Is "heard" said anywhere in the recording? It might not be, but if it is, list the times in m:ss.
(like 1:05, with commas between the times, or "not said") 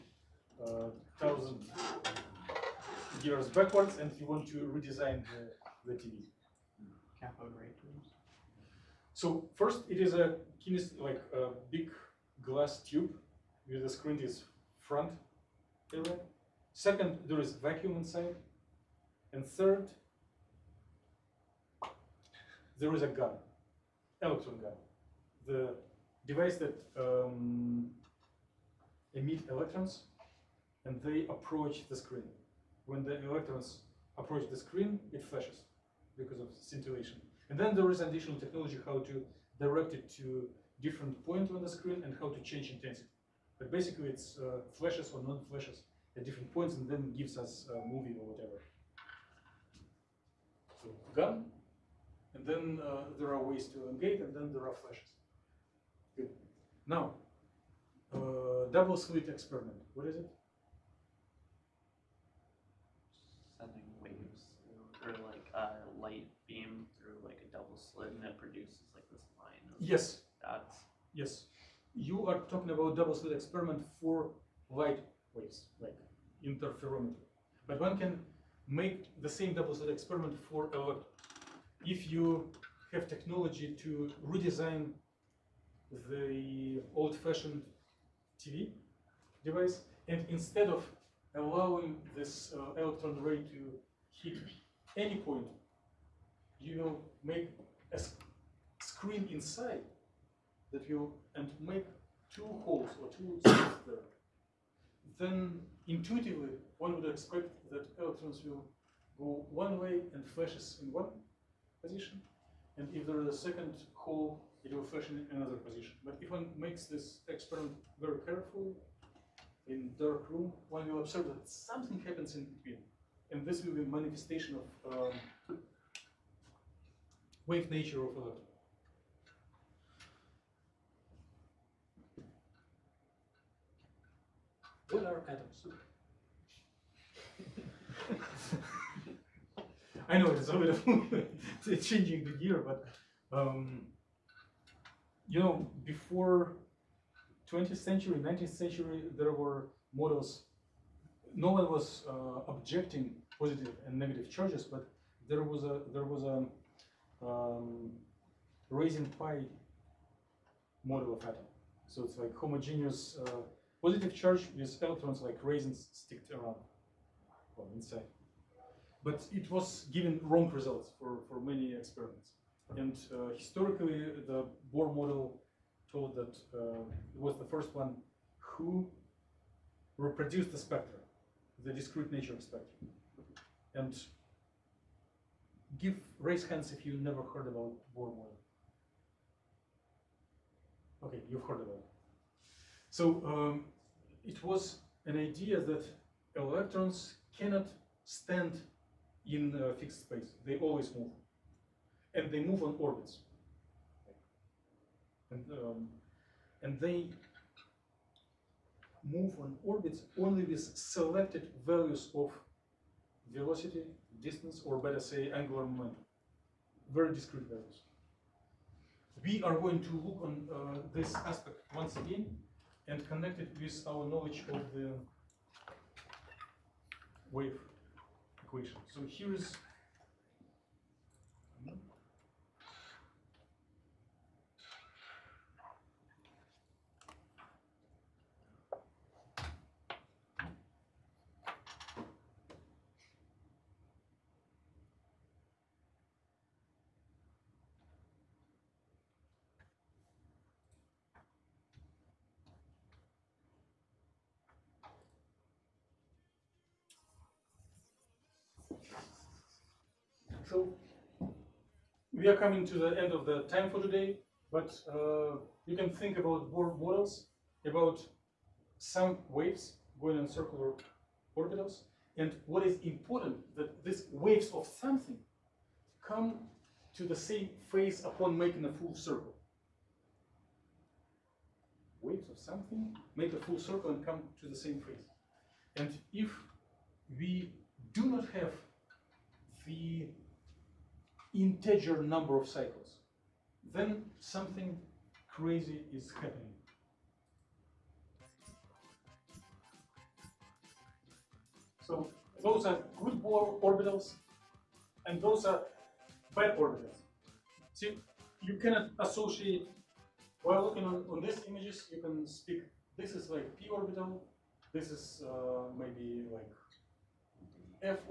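3:07, 3:11.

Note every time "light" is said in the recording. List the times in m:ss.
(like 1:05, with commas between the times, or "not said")
1:06, 1:14.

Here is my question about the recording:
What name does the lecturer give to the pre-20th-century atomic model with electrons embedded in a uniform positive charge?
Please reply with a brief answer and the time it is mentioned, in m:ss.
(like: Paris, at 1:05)
Raisin pie model, at 2:38.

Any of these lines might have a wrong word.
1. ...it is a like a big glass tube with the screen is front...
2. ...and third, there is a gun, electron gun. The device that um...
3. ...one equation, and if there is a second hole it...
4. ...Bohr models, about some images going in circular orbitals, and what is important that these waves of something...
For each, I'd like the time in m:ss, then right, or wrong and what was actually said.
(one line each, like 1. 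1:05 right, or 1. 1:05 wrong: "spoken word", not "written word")
1. 0:09 right
2. 0:19 right
3. 1:50 wrong: "position", not "equation"
4. 4:26 wrong: "waves", not "images".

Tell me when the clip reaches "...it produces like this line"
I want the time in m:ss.
1:08.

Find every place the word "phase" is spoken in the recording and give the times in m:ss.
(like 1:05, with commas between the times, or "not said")
4:37, 4:44.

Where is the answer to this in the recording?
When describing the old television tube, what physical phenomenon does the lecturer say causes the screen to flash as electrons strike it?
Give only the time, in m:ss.
0:36.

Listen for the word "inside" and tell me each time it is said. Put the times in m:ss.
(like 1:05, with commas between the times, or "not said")
0:17, 1:39, 2:47.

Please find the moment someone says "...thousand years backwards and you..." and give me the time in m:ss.
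0:01.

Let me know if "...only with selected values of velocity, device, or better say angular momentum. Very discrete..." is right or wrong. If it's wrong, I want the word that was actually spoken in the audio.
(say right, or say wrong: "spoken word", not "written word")
wrong: "distance", not "device".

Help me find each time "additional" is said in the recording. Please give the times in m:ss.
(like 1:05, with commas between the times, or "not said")
0:38.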